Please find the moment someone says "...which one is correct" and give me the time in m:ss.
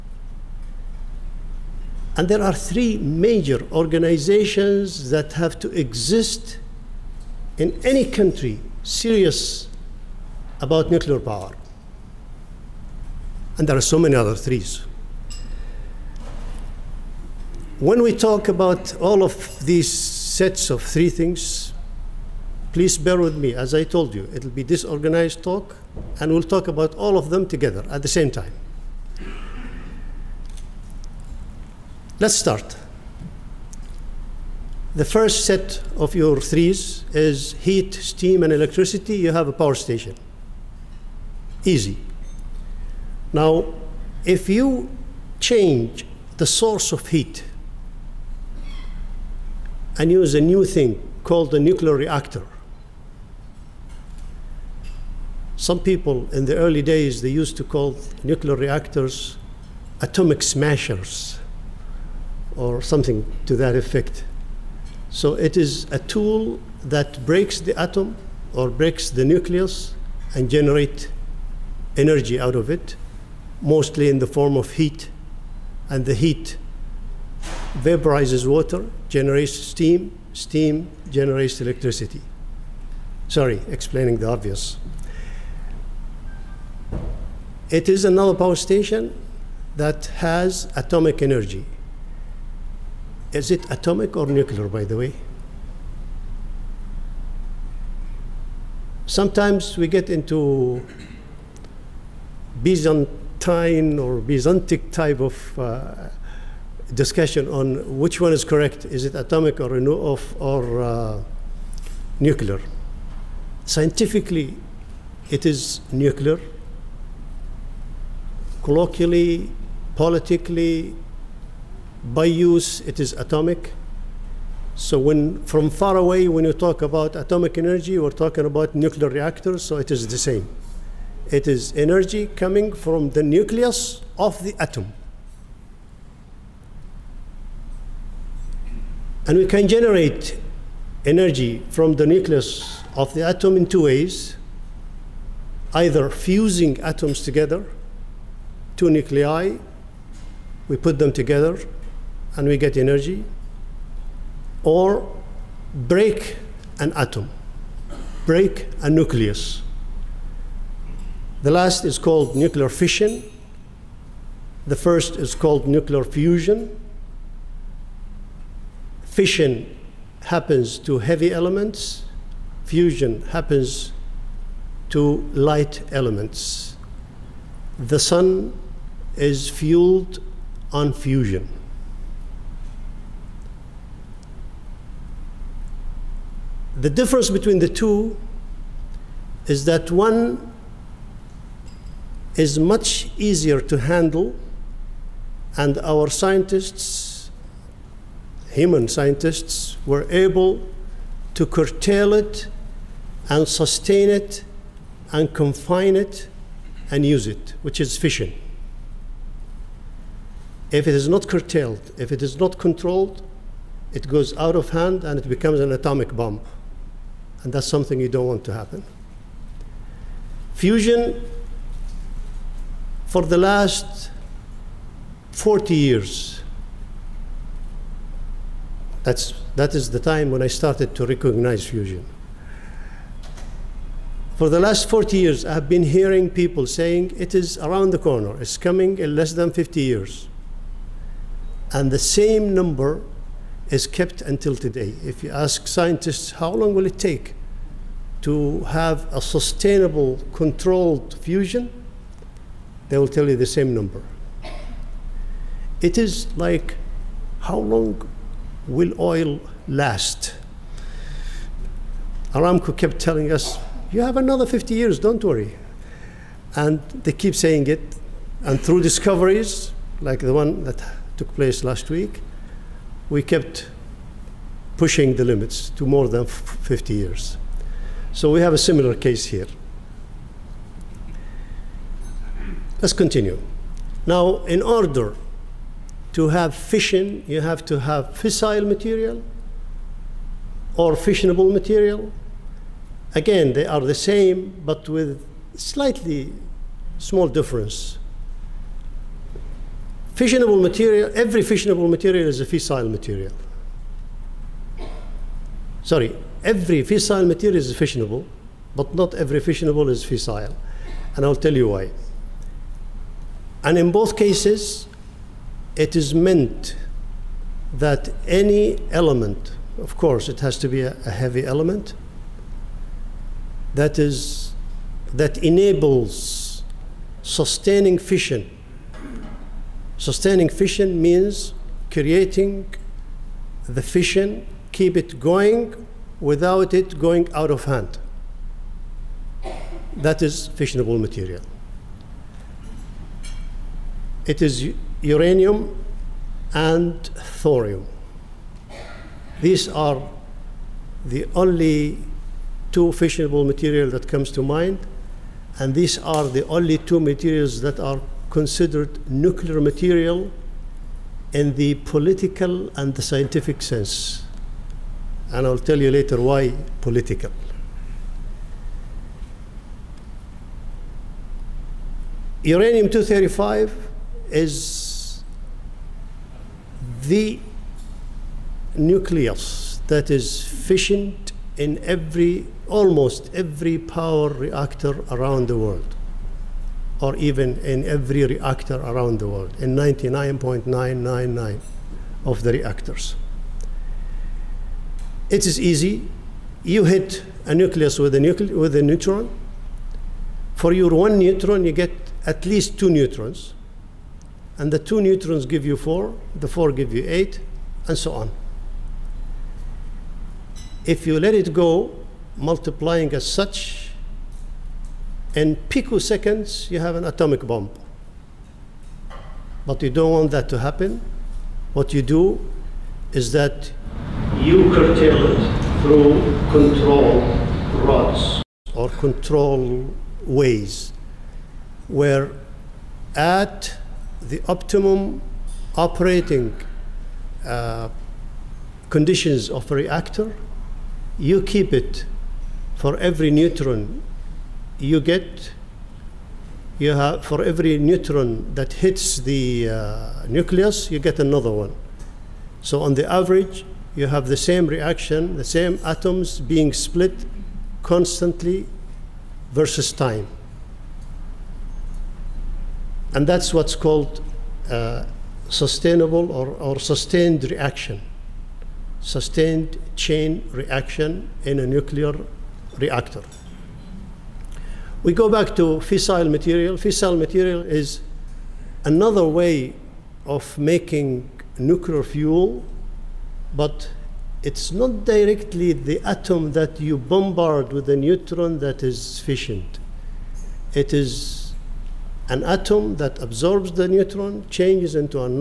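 1:47.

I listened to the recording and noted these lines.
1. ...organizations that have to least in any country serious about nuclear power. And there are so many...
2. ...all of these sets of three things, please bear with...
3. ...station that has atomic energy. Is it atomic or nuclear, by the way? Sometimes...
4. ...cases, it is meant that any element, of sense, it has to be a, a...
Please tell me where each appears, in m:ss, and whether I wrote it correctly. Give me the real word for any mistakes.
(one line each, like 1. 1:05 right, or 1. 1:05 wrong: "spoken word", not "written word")
1. 0:03 wrong: "exist", not "least"
2. 0:18 right
3. 1:28 right
4. 5:14 wrong: "course", not "sense".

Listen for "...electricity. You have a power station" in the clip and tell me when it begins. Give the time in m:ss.
0:38.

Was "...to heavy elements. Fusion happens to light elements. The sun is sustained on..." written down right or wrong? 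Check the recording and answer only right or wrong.
wrong.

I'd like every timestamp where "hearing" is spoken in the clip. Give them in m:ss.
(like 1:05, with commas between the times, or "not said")
3:55.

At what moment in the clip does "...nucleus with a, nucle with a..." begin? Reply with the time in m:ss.
6:37.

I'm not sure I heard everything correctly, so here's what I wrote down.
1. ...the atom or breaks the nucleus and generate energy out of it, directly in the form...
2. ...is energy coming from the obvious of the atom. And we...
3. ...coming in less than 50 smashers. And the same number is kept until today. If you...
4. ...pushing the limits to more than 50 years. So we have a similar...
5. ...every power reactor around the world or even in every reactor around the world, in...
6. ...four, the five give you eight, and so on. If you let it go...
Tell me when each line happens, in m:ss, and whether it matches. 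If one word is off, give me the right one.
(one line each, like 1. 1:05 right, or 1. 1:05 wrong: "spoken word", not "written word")
1. 1:07 wrong: "mostly", not "directly"
2. 2:11 wrong: "nucleus", not "obvious"
3. 3:58 wrong: "years", not "smashers"
4. 4:34 right
5. 6:23 right
6. 6:45 wrong: "four", not "five".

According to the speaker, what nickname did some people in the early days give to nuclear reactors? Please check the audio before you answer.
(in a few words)
Atomic smashers.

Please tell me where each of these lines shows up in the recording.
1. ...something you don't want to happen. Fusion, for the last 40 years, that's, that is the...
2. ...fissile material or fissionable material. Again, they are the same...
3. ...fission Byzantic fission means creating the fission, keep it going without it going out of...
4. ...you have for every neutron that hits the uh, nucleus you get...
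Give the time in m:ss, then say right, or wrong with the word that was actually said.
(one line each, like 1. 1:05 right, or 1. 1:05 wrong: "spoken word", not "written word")
1. 3:37 right
2. 4:48 right
3. 5:27 wrong: "Sustaining", not "Byzantic"
4. 7:26 right.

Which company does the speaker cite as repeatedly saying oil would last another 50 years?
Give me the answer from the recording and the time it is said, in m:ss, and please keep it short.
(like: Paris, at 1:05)
Aramco, at 4:22.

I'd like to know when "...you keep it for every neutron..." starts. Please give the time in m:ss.
7:21.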